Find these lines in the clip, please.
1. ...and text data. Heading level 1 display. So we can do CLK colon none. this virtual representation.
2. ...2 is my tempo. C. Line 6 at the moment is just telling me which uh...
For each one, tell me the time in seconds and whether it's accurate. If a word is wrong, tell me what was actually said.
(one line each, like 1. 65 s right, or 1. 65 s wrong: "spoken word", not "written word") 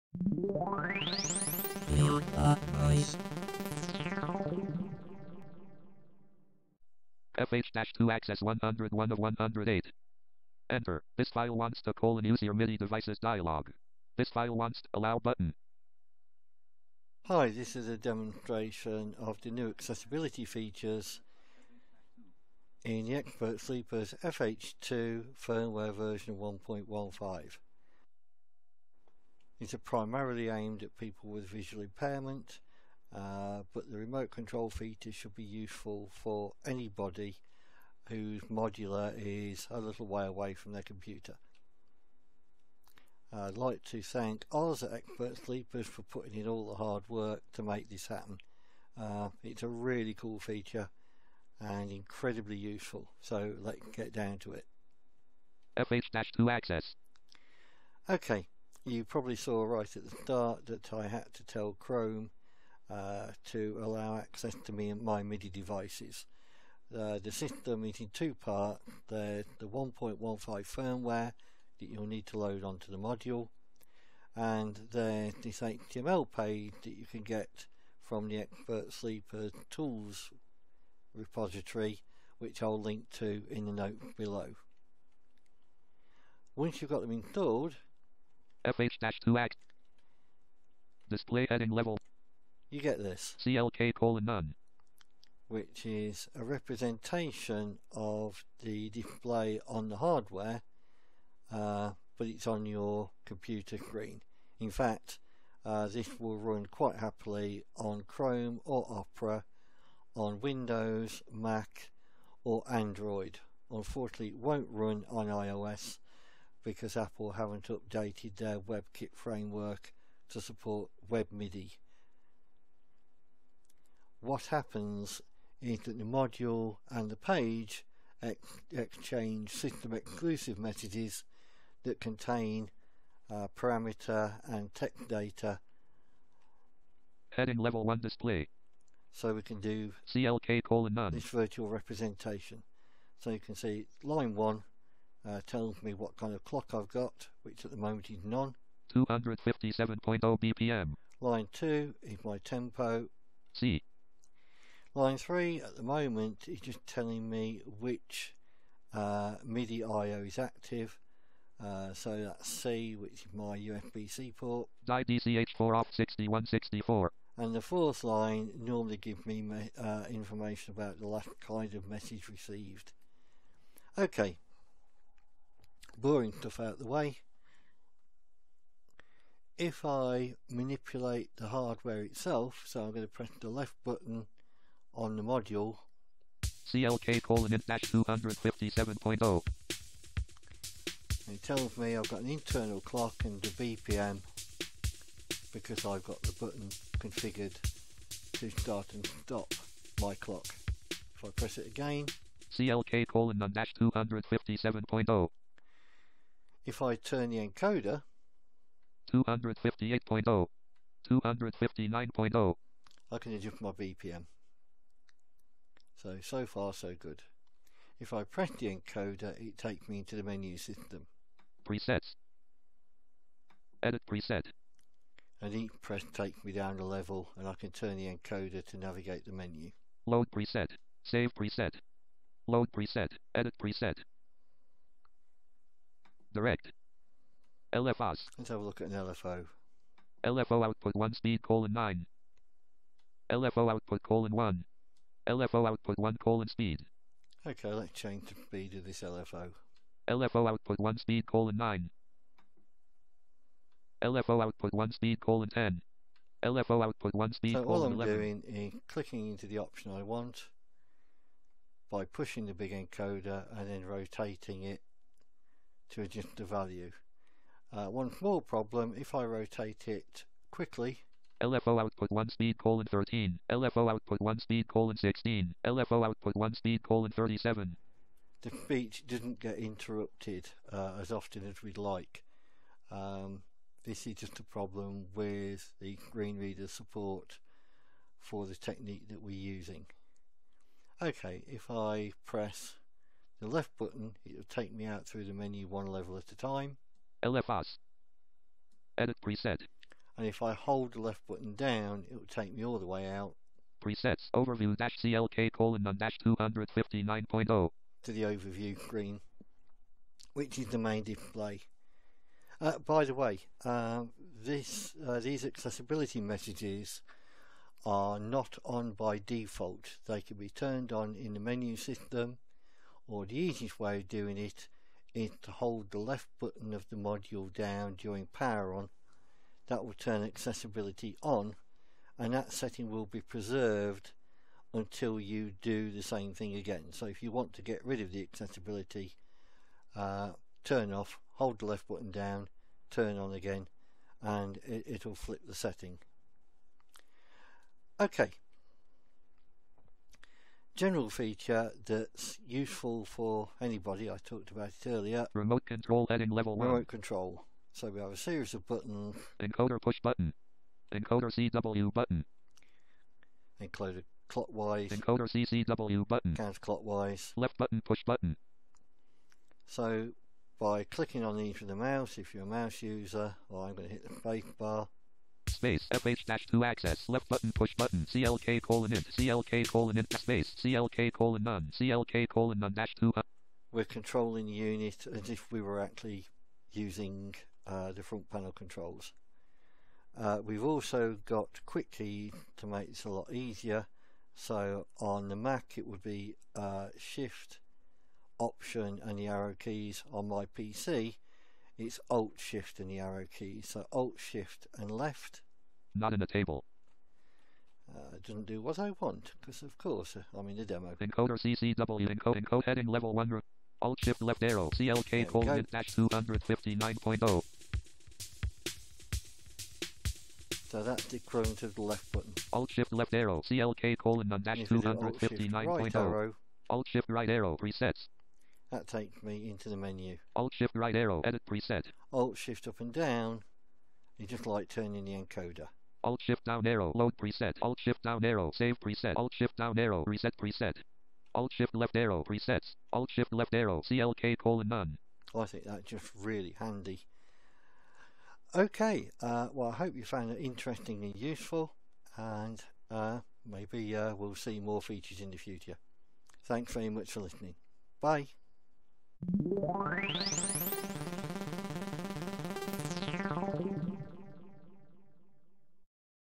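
1. 134 s right
2. 151 s wrong: "3", not "6".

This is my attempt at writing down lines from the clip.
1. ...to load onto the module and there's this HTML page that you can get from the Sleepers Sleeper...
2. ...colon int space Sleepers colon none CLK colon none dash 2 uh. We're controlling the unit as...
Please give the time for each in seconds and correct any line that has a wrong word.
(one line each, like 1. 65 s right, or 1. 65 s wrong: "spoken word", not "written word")
1. 72 s wrong: "Expert", not "Sleepers"
2. 379 s wrong: "CLK", not "Sleepers".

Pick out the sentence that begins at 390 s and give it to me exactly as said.
Uh, we've also got quick key to make this a lot easier.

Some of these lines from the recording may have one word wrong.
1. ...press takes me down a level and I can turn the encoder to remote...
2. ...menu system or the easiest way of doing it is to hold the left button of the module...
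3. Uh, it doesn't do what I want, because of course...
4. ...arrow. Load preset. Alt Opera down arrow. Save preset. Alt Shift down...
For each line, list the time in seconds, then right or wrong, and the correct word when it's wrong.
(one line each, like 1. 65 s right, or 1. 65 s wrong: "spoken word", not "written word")
1. 225 s wrong: "navigate", not "remote"
2. 321 s right
3. 407 s right
4. 436 s wrong: "Shift", not "Opera".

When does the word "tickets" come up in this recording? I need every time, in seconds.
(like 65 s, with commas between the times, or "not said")
not said.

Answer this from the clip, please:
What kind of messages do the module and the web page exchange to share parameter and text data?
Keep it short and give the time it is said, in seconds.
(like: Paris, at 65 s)
System exclusive messages, at 129 s.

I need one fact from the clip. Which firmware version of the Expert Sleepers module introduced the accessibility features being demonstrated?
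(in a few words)
1.15.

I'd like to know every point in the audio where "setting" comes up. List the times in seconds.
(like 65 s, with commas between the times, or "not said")
332 s, 345 s.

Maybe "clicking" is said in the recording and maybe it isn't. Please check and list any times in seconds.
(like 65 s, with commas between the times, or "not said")
258 s, 370 s.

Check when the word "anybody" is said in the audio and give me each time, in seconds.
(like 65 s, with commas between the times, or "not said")
36 s, 353 s.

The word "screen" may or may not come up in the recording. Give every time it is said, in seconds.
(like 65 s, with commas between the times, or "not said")
103 s, 286 s, 308 s.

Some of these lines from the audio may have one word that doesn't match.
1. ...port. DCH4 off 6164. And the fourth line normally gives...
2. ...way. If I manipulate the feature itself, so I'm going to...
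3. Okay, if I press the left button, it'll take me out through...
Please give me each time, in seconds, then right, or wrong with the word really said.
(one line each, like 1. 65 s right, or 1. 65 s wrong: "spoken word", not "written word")
1. 164 s right
2. 176 s wrong: "hardware", not "feature"
3. 291 s right.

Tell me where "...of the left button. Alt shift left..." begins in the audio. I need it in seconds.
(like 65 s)
421 s.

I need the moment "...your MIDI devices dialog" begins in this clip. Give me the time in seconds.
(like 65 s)
12 s.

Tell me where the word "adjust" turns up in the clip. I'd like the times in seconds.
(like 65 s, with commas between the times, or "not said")
213 s, 266 s.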